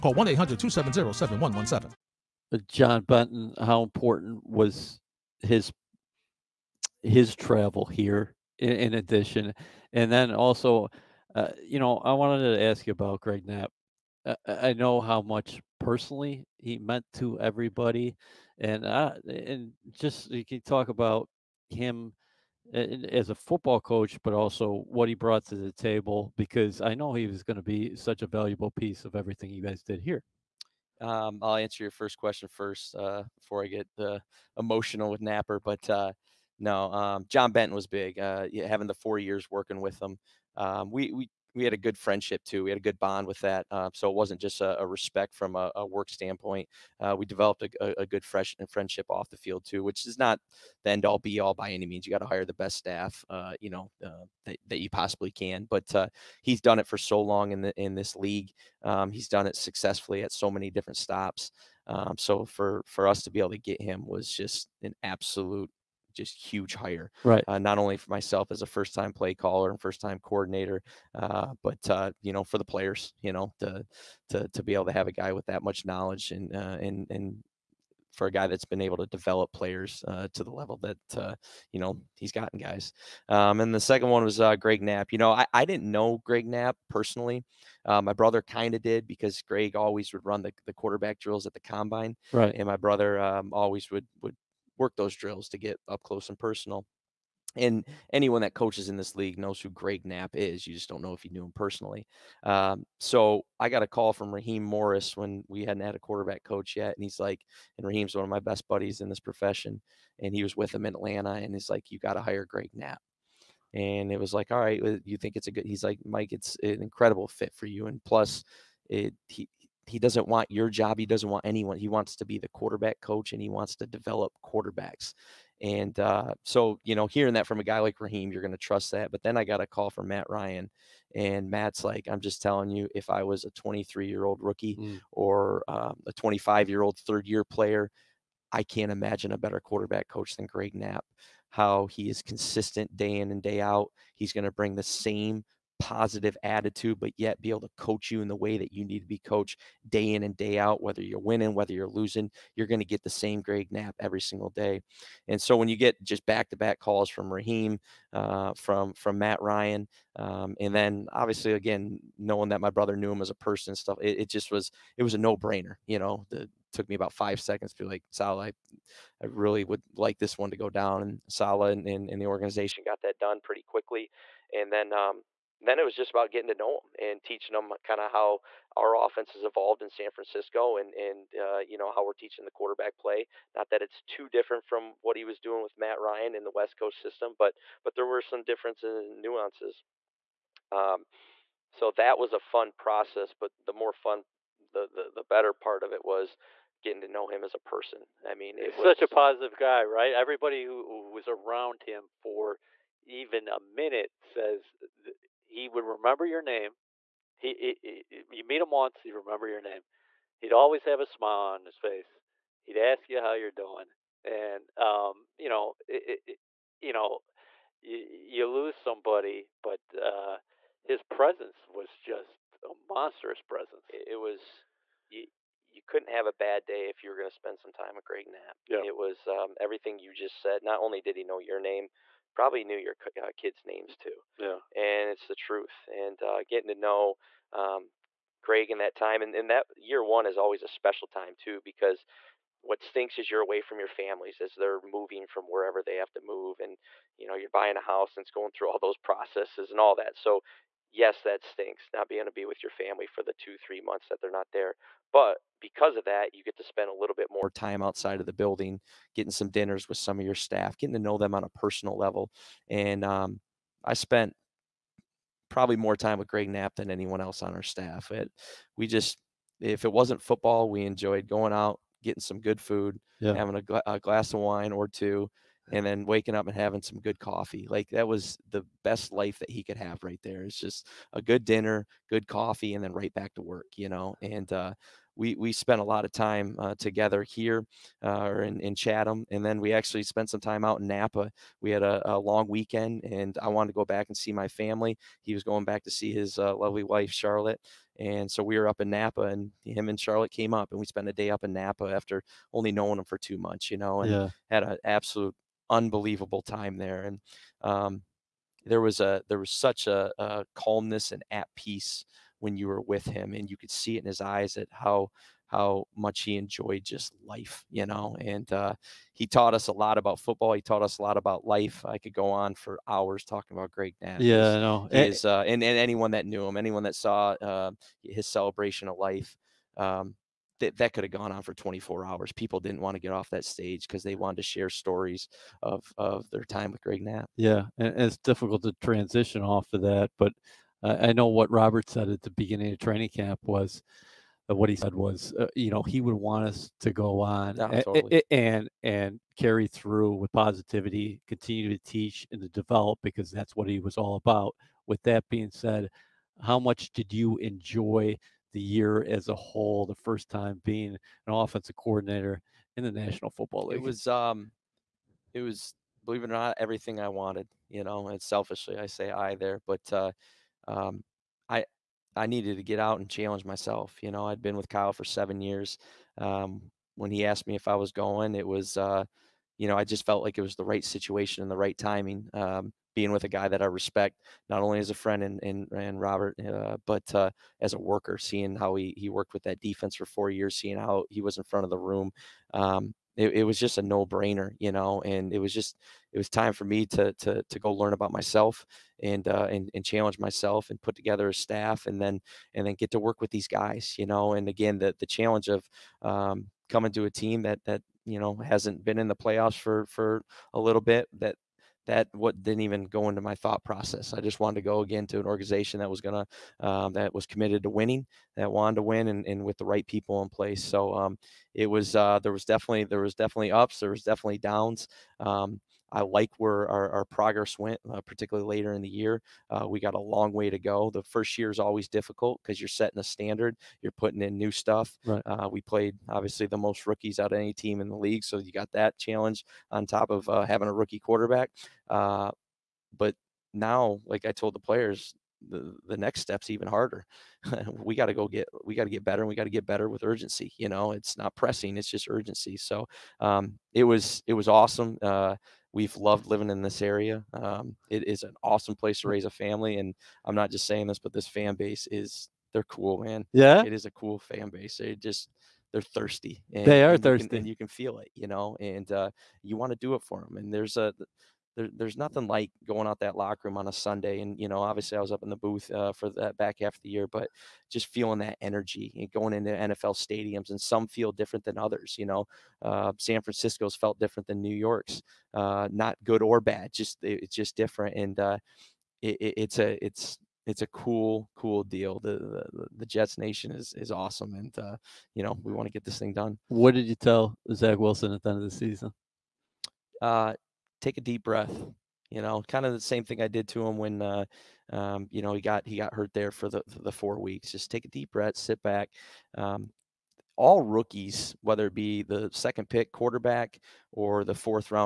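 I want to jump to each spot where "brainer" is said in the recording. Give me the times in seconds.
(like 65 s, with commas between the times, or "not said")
165 s, 394 s.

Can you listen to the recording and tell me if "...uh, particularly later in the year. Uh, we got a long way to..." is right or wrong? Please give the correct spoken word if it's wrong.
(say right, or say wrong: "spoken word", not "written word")
right.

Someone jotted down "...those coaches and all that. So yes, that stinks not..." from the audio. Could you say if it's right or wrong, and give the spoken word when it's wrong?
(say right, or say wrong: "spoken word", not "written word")
wrong: "processes", not "coaches".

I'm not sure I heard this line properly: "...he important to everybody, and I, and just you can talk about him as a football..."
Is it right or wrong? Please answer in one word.
wrong.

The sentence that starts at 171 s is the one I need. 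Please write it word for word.
And Saleh and, and, and the organization got that done pretty quickly.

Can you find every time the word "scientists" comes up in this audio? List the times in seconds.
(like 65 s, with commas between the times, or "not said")
not said.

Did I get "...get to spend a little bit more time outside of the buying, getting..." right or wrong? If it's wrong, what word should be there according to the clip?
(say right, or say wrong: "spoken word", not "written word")
wrong: "building", not "buying".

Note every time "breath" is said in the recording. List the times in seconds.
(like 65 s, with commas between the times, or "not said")
501 s, 508 s.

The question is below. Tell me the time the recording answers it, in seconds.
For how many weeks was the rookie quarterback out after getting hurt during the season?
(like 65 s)
506 s.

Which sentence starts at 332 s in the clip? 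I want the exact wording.
People didn't want to get off that stage because they wanted to share stories of, of their time with Greg Knapp.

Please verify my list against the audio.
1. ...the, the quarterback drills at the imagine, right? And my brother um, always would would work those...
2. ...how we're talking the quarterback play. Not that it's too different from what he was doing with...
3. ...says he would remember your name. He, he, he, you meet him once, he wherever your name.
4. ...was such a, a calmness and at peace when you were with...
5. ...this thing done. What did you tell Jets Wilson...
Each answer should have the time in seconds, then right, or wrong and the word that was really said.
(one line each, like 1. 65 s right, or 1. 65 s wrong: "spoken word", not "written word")
1. 90 s wrong: "combine", not "imagine"
2. 181 s wrong: "teaching", not "talking"
3. 204 s wrong: "remember", not "wherever"
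4. 309 s right
5. 495 s wrong: "Zach", not "Jets".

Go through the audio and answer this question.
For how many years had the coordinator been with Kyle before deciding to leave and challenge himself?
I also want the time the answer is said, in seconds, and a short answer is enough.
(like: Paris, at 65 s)
7, at 375 s.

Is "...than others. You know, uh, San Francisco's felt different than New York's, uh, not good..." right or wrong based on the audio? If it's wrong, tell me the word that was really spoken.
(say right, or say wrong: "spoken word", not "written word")
right.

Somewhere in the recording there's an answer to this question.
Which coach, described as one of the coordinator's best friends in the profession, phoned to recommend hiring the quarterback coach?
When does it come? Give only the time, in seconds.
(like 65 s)
104 s.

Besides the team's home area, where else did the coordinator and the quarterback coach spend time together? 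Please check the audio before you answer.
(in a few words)
Chatham.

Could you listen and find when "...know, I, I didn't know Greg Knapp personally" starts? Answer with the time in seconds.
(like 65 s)
85 s.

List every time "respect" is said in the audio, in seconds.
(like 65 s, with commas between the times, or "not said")
44 s, 383 s.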